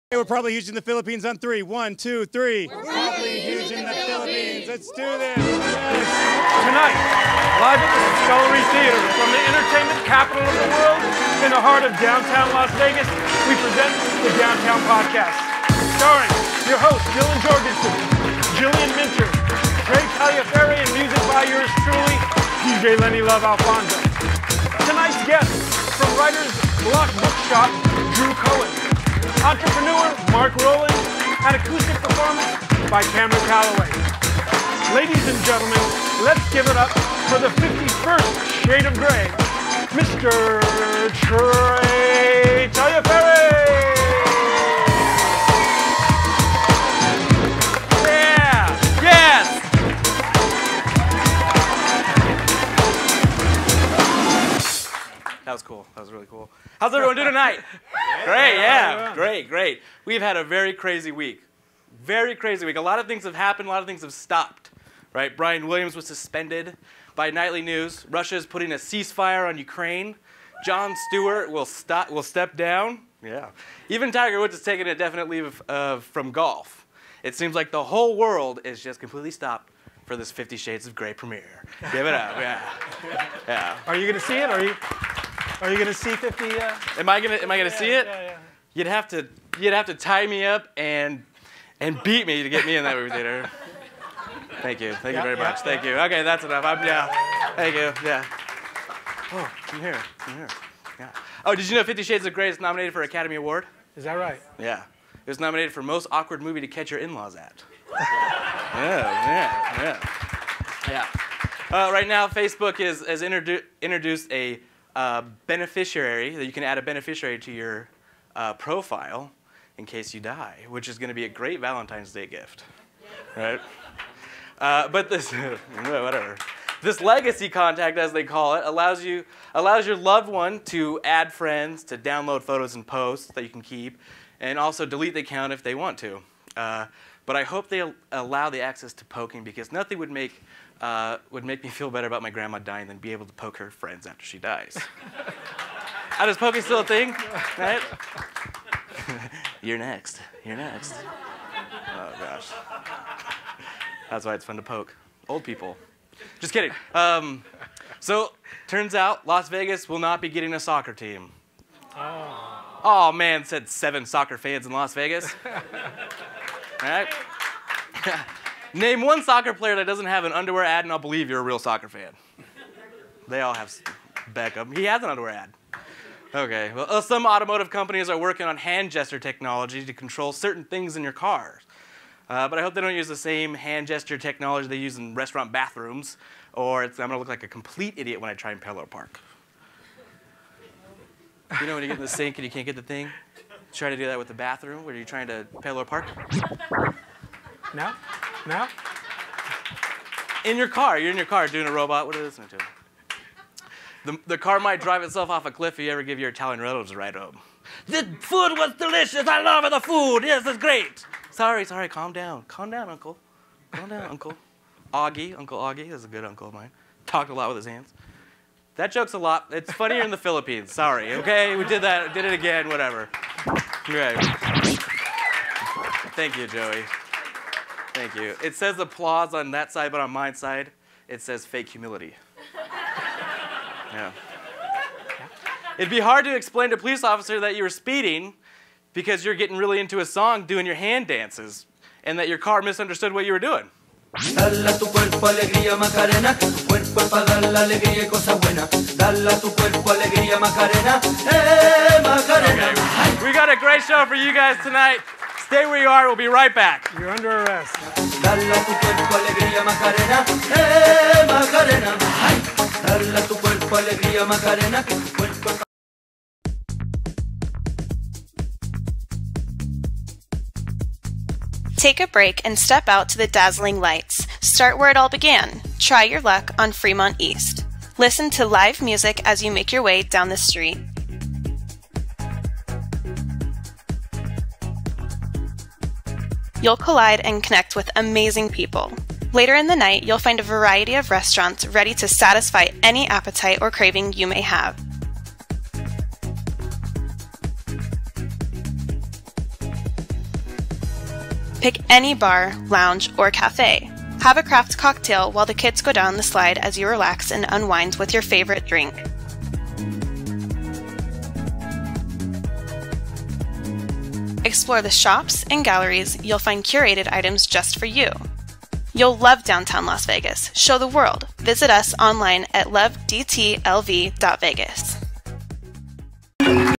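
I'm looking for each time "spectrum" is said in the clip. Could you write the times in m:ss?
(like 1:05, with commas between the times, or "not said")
not said.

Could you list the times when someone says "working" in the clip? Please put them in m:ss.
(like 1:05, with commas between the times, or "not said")
2:58.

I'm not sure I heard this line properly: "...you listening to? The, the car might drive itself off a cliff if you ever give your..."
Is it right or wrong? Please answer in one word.
right.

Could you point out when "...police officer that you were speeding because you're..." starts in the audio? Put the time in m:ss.
3:56.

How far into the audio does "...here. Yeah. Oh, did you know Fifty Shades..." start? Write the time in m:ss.
1:40.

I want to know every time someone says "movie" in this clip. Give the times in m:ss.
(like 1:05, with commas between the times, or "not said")
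1:32, 1:46.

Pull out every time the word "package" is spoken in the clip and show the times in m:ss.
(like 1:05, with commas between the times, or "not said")
not said.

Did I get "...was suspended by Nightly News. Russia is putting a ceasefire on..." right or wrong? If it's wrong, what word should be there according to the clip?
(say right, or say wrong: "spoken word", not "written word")
right.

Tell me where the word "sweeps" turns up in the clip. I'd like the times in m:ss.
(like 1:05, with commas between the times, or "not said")
not said.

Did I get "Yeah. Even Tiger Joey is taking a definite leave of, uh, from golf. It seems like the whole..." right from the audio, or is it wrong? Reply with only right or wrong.
wrong.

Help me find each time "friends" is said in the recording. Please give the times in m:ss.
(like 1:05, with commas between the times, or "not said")
2:11, 2:23.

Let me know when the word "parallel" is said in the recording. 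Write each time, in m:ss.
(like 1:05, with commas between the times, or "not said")
3:08, 3:15.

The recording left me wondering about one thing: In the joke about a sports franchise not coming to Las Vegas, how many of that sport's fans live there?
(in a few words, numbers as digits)
7.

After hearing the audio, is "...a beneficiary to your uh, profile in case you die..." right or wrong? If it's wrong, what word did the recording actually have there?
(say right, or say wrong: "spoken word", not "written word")
right.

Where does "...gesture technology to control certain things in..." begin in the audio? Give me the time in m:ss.
2:58.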